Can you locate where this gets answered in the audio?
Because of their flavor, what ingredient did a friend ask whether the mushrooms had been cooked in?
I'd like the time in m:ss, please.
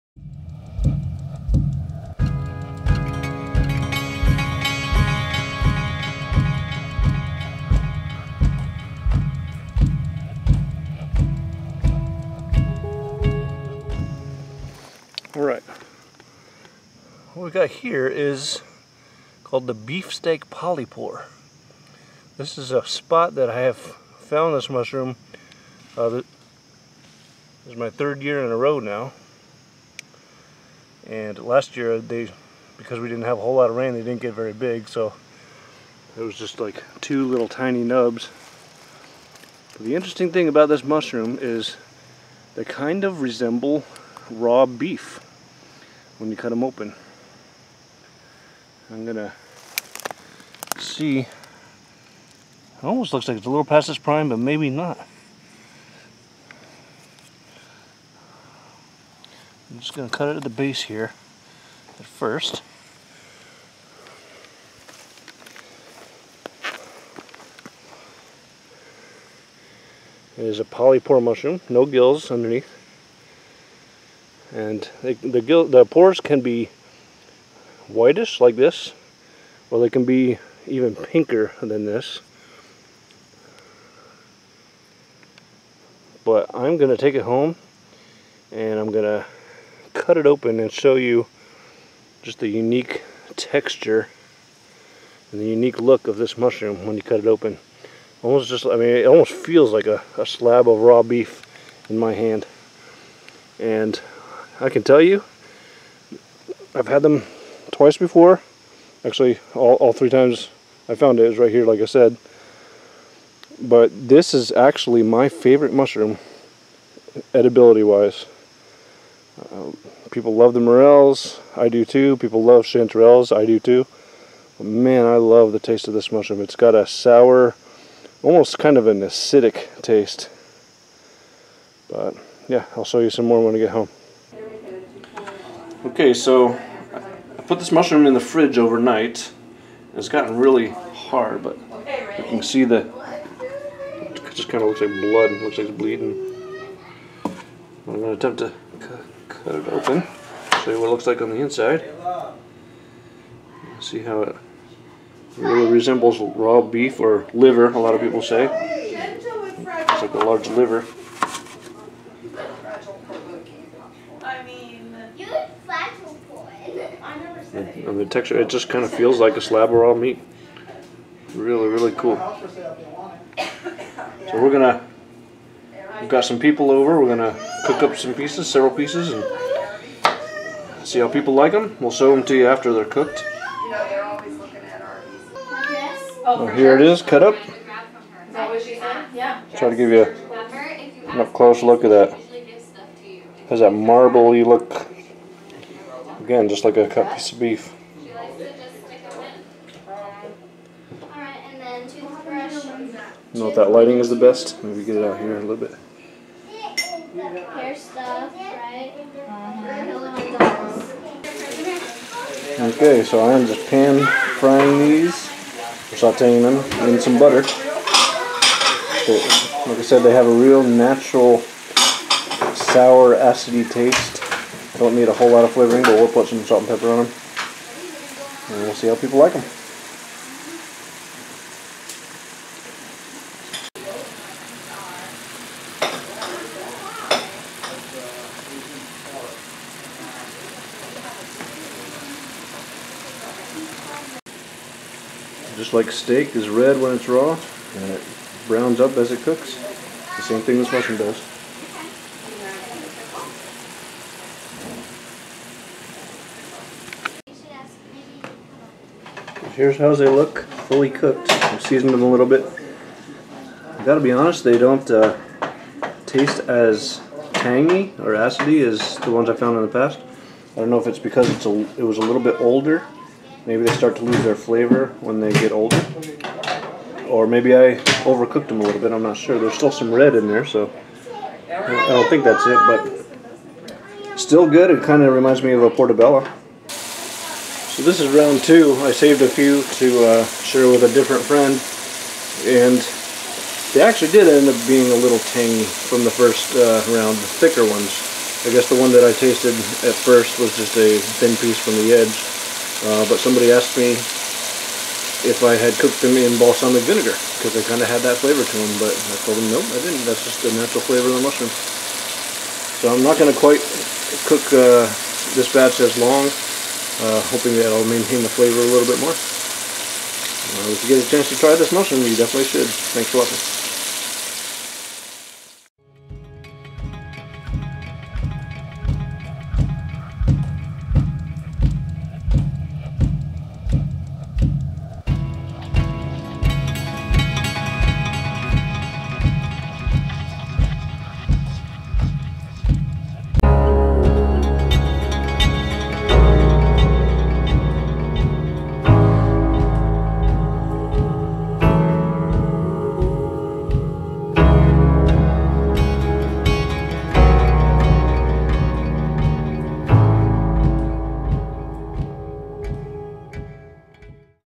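5:06.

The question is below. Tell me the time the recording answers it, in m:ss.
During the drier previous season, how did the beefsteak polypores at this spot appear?
0:36.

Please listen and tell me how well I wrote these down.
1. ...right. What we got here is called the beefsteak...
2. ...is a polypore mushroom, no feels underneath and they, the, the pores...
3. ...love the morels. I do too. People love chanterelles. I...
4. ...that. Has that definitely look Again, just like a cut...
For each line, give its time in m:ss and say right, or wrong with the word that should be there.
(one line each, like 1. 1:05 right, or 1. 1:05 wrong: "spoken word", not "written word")
1. 0:15 right
2. 1:10 wrong: "gills", not "feels"
3. 2:00 right
4. 3:11 wrong: "marbly", not "definitely".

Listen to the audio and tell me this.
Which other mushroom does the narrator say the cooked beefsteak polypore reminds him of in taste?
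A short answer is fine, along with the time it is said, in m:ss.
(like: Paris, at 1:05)
portobello, at 4:45.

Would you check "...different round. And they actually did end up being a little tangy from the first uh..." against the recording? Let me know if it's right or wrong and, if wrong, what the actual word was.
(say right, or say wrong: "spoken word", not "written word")
wrong: "friend", not "round".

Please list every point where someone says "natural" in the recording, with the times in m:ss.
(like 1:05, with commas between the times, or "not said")
3:40, 5:10.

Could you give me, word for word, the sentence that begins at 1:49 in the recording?
Actually, all, all three times I found it is right here, like I said.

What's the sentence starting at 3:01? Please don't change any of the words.
We'll show them to you after they're cooked.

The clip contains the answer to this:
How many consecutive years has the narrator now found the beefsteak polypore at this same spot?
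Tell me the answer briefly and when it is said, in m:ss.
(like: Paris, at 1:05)
3, at 0:27.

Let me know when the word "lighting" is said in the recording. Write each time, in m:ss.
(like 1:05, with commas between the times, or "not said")
3:23.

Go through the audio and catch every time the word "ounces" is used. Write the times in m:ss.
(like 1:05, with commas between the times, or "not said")
not said.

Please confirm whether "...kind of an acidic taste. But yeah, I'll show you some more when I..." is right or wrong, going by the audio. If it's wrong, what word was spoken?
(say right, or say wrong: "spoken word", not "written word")
right.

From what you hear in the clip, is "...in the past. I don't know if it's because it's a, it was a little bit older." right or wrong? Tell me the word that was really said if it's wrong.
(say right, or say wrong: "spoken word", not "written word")
right.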